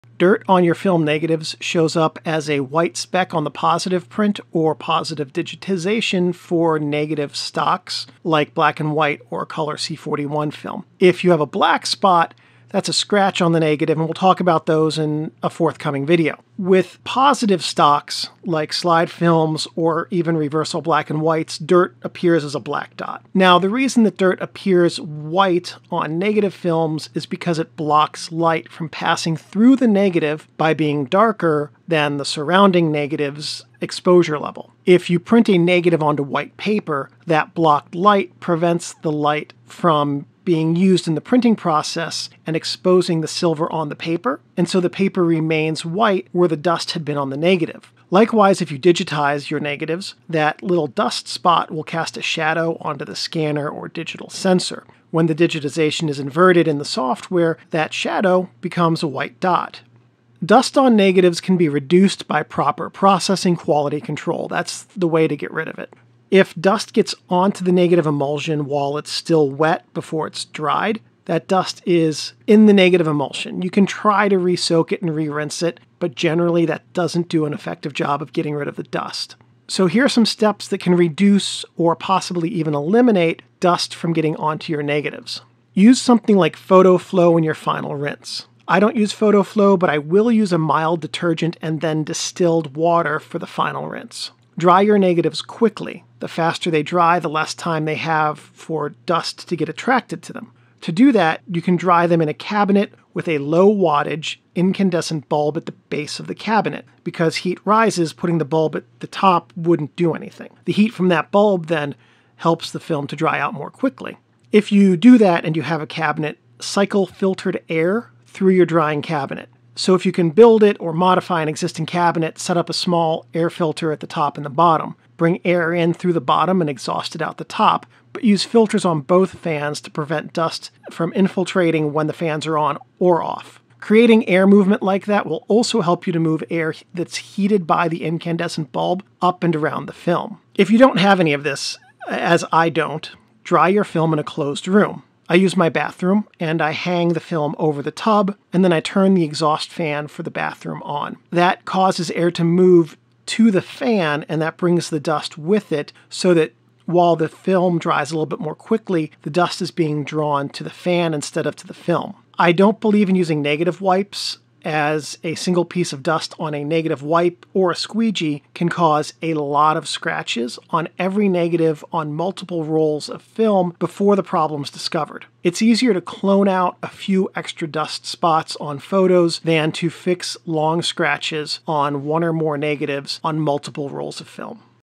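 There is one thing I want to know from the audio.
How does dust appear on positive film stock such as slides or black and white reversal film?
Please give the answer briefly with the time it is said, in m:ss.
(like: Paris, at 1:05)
black dot, at 0:22.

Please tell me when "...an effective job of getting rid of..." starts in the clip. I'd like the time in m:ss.
1:17.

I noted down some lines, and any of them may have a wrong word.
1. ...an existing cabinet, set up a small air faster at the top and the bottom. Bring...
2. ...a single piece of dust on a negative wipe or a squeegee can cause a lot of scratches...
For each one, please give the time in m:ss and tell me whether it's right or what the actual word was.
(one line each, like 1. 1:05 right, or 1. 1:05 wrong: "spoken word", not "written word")
1. 2:01 wrong: "filter", not "faster"
2. 2:45 right.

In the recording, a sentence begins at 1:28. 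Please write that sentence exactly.
I don't use Photo-Flo, but I will use a mild detergent and then distilled water for the final rinse.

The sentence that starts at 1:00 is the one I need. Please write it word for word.
Dust on negatives can be reduced by proper processing quality control.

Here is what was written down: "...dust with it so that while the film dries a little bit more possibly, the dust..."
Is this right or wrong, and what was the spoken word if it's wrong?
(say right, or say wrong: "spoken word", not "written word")
wrong: "quickly", not "possibly".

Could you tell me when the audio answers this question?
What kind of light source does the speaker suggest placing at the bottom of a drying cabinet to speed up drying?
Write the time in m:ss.
1:43.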